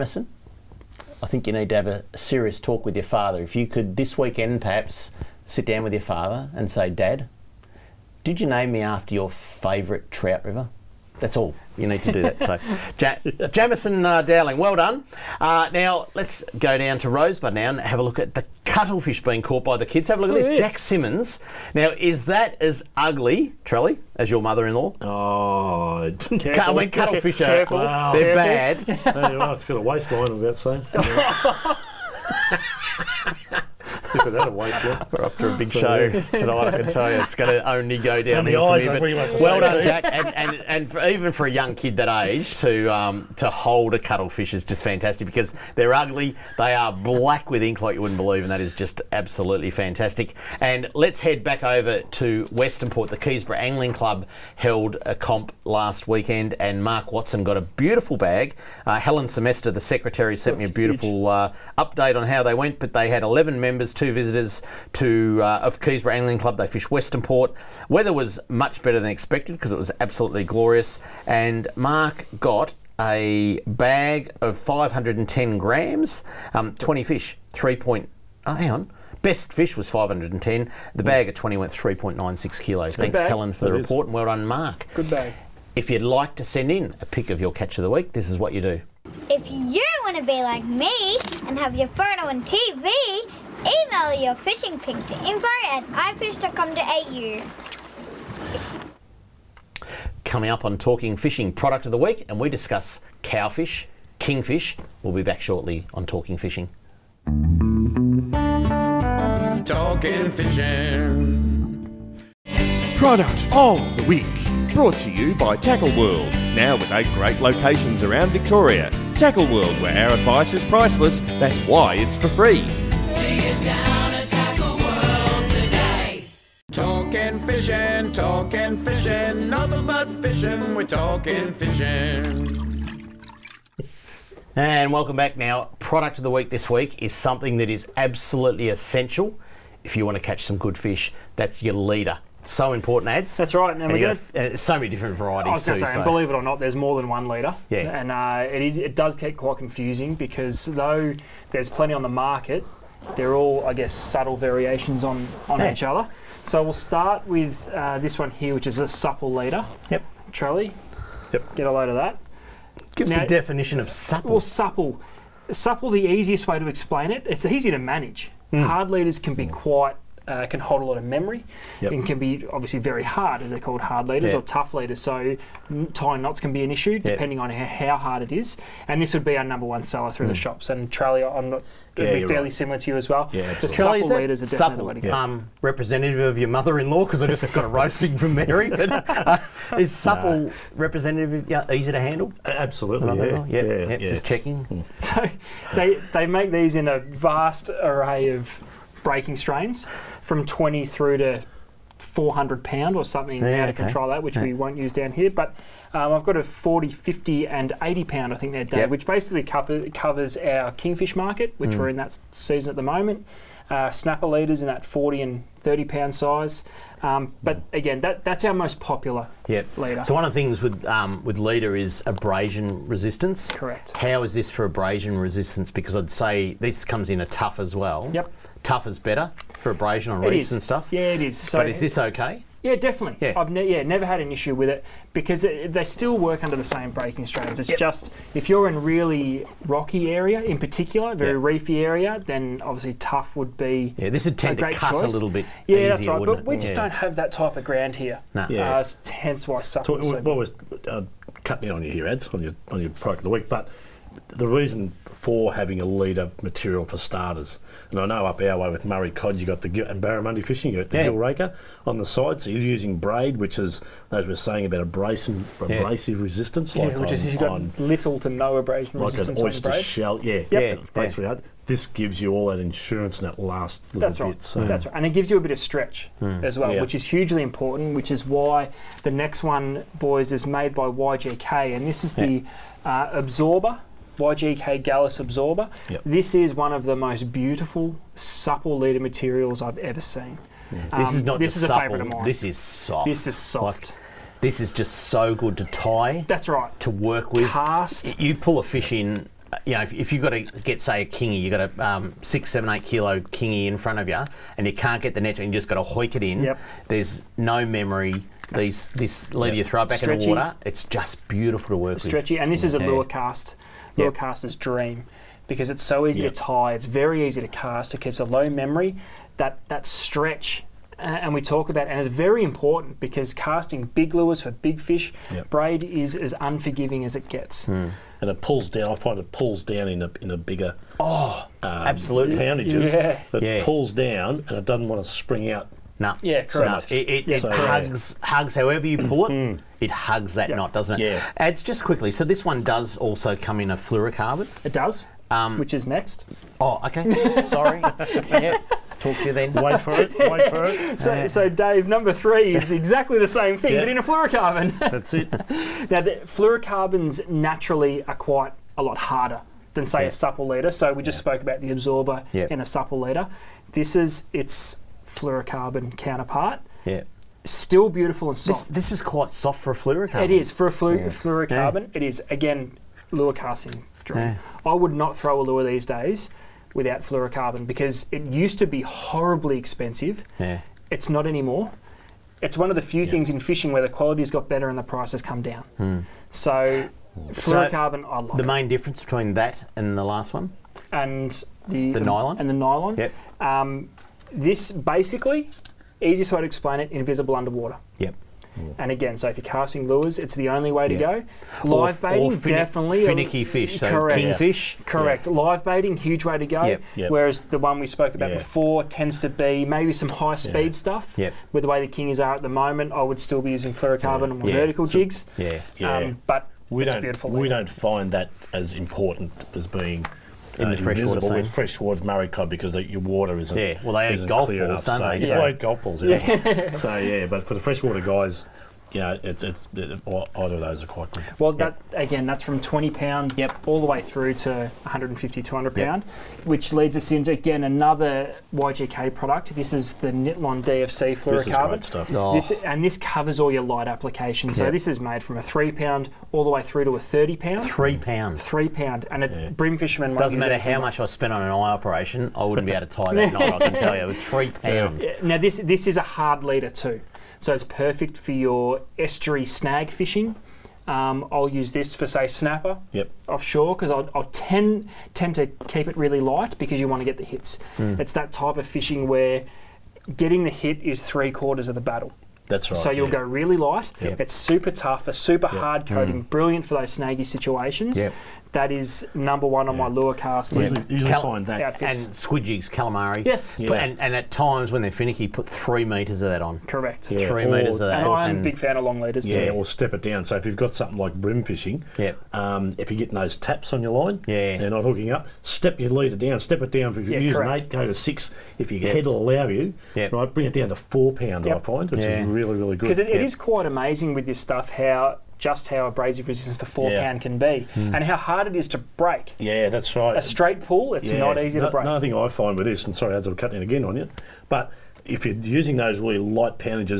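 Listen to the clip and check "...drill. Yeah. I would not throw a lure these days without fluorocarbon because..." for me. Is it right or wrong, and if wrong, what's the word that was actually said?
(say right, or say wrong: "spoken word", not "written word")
right.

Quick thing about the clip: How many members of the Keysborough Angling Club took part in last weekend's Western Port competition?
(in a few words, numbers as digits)
11.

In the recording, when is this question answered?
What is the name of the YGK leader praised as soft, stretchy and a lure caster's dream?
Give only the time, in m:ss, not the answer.
4:44.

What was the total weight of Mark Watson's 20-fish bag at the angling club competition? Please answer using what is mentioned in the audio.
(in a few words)
3.96 kilos.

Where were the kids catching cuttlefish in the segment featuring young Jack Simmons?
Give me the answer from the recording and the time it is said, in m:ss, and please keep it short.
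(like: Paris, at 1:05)
Rosebud, at 0:17.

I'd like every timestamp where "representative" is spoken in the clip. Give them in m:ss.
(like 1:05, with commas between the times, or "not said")
3:05, 3:10.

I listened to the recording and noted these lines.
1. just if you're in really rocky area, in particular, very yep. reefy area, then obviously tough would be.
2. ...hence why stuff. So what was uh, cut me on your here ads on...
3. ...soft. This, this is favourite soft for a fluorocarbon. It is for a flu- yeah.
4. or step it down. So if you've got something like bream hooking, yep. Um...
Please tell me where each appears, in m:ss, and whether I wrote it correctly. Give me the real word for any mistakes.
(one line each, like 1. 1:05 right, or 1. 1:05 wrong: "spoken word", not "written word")
1. 3:57 right
2. 4:09 right
3. 6:08 wrong: "quite", not "favourite"
4. 8:09 wrong: "fishing", not "hooking".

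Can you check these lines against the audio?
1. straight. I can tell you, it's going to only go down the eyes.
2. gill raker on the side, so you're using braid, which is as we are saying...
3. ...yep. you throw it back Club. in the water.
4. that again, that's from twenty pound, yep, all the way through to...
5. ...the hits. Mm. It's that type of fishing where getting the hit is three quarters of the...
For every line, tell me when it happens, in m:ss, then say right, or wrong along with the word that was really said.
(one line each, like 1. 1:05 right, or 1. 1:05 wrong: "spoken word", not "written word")
1. 0:36 wrong: "tonight", not "straight"
2. 4:21 right
3. 5:09 wrong: "Stretchy", not "Club"
4. 7:11 right
5. 7:47 right.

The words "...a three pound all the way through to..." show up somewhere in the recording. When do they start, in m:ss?
7:25.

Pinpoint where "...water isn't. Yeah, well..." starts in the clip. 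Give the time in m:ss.
7:03.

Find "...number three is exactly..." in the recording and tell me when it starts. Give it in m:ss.
5:51.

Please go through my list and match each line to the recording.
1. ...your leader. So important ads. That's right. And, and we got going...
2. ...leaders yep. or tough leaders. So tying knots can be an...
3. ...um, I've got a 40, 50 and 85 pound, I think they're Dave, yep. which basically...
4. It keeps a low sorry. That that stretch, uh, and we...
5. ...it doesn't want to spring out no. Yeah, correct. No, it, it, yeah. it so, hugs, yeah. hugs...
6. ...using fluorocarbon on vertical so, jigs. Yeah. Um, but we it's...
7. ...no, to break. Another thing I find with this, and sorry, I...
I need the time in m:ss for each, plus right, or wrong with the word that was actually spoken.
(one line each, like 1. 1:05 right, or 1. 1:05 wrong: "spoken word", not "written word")
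1. 2:21 right
2. 2:54 right
3. 3:25 wrong: "80", not "85"
4. 5:17 wrong: "memory", not "sorry"
5. 5:34 right
6. 6:53 right
7. 8:31 right.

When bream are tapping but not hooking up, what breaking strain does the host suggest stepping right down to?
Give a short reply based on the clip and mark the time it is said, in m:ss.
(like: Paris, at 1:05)
4 pound, at 8:20.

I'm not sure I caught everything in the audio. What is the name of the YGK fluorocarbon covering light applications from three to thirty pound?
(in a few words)
Nitlon DFC.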